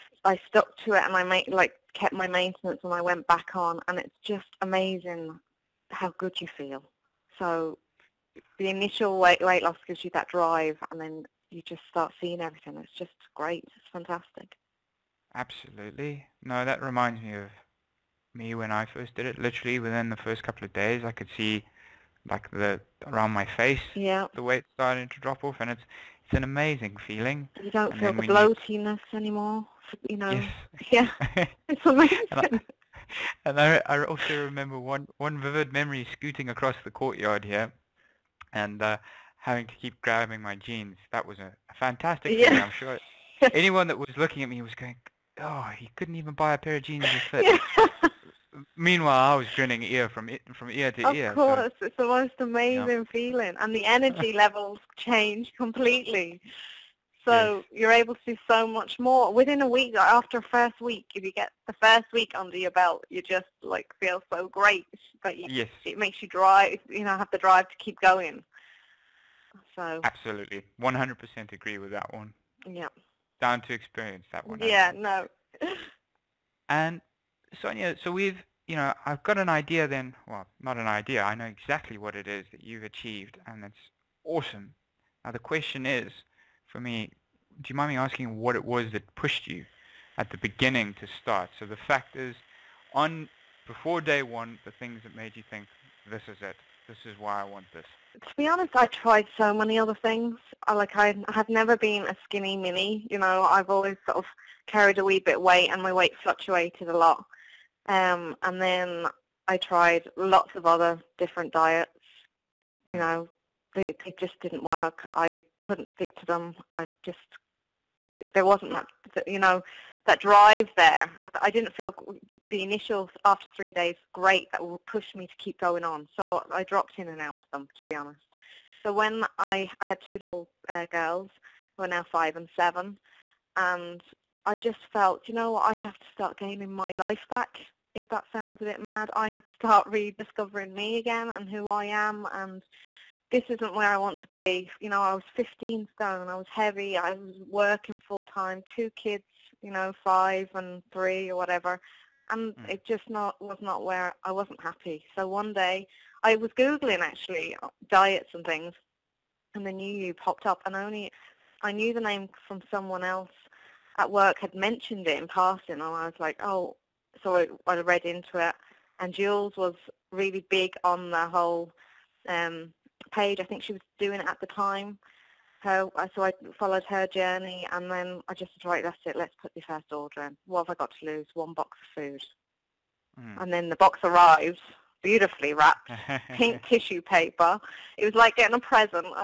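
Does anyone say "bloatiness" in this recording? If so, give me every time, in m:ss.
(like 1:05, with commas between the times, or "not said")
0:28.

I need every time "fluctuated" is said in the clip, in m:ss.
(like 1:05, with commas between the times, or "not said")
1:46.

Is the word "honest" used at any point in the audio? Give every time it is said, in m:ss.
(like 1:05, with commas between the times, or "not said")
1:38, 2:07.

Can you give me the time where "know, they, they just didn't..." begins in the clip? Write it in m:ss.
1:52.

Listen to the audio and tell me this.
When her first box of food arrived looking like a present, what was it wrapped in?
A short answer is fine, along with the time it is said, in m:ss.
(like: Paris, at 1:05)
Pink tissue paper, at 3:06.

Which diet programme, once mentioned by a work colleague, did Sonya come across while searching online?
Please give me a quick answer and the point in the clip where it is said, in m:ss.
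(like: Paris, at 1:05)
The New You, at 2:39.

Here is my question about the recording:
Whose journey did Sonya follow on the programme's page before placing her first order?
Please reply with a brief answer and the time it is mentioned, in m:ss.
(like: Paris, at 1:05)
Jules, at 2:49.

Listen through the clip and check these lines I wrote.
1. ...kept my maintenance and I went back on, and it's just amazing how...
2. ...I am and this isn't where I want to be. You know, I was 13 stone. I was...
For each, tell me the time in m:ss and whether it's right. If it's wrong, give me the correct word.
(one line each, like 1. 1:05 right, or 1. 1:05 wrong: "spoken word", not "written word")
1. 0:01 right
2. 2:21 wrong: "15", not "13".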